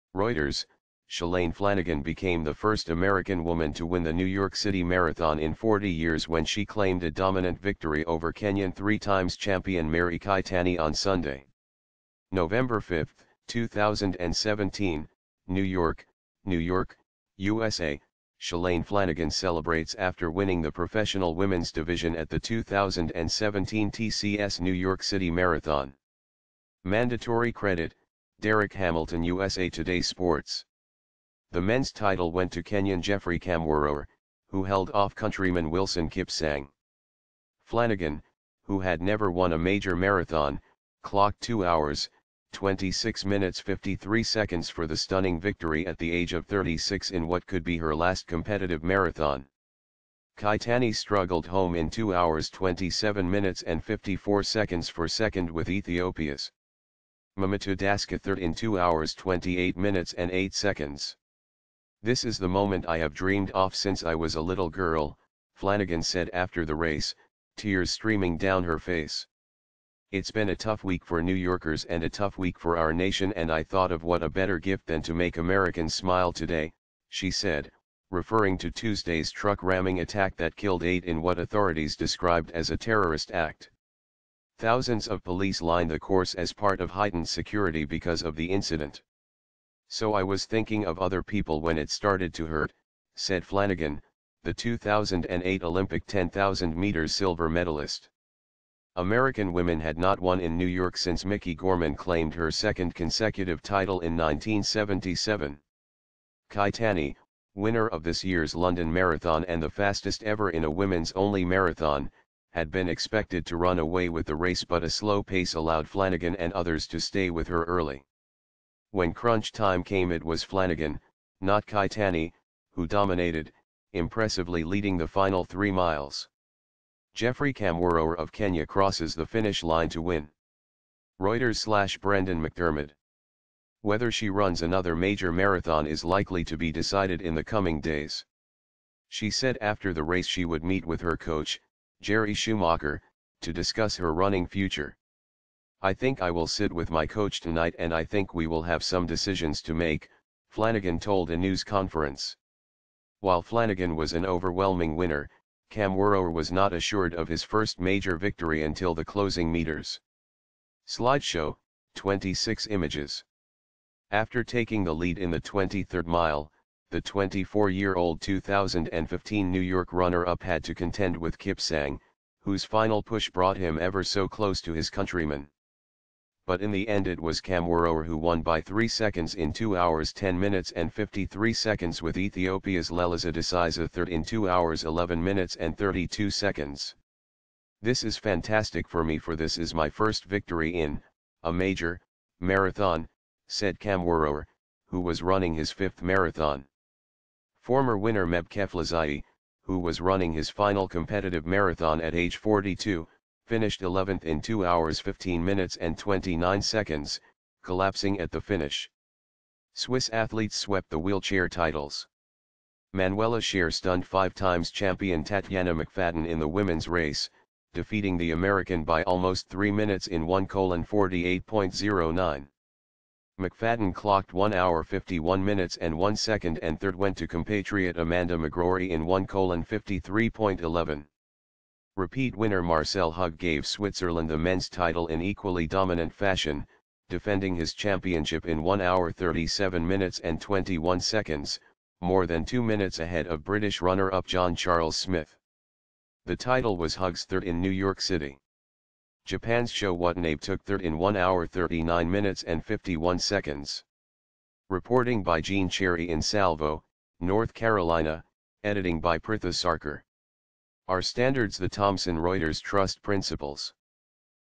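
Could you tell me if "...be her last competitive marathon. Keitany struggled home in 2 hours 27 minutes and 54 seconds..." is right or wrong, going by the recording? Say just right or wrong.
right.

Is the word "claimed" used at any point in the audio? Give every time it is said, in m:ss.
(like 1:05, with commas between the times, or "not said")
0:06, 1:41.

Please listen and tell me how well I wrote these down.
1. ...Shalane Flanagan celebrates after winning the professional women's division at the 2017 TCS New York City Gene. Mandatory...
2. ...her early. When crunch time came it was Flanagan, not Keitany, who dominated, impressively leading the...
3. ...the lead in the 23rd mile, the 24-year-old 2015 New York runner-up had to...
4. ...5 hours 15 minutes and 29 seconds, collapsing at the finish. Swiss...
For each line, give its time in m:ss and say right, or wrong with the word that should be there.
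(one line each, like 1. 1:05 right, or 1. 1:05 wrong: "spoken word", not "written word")
1. 0:18 wrong: "Marathon", not "Gene"
2. 1:57 right
3. 2:44 right
4. 3:24 wrong: "2", not "5".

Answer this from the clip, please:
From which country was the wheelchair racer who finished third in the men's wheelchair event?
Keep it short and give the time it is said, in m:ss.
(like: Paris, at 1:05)
Japan, at 4:09.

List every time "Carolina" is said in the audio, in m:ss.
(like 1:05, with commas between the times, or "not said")
4:17.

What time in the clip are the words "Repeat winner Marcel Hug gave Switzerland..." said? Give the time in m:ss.
3:51.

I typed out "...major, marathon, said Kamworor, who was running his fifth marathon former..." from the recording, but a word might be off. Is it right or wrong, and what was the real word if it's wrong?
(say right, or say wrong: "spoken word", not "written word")
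right.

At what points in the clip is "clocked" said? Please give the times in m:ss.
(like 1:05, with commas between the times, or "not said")
0:41, 3:43.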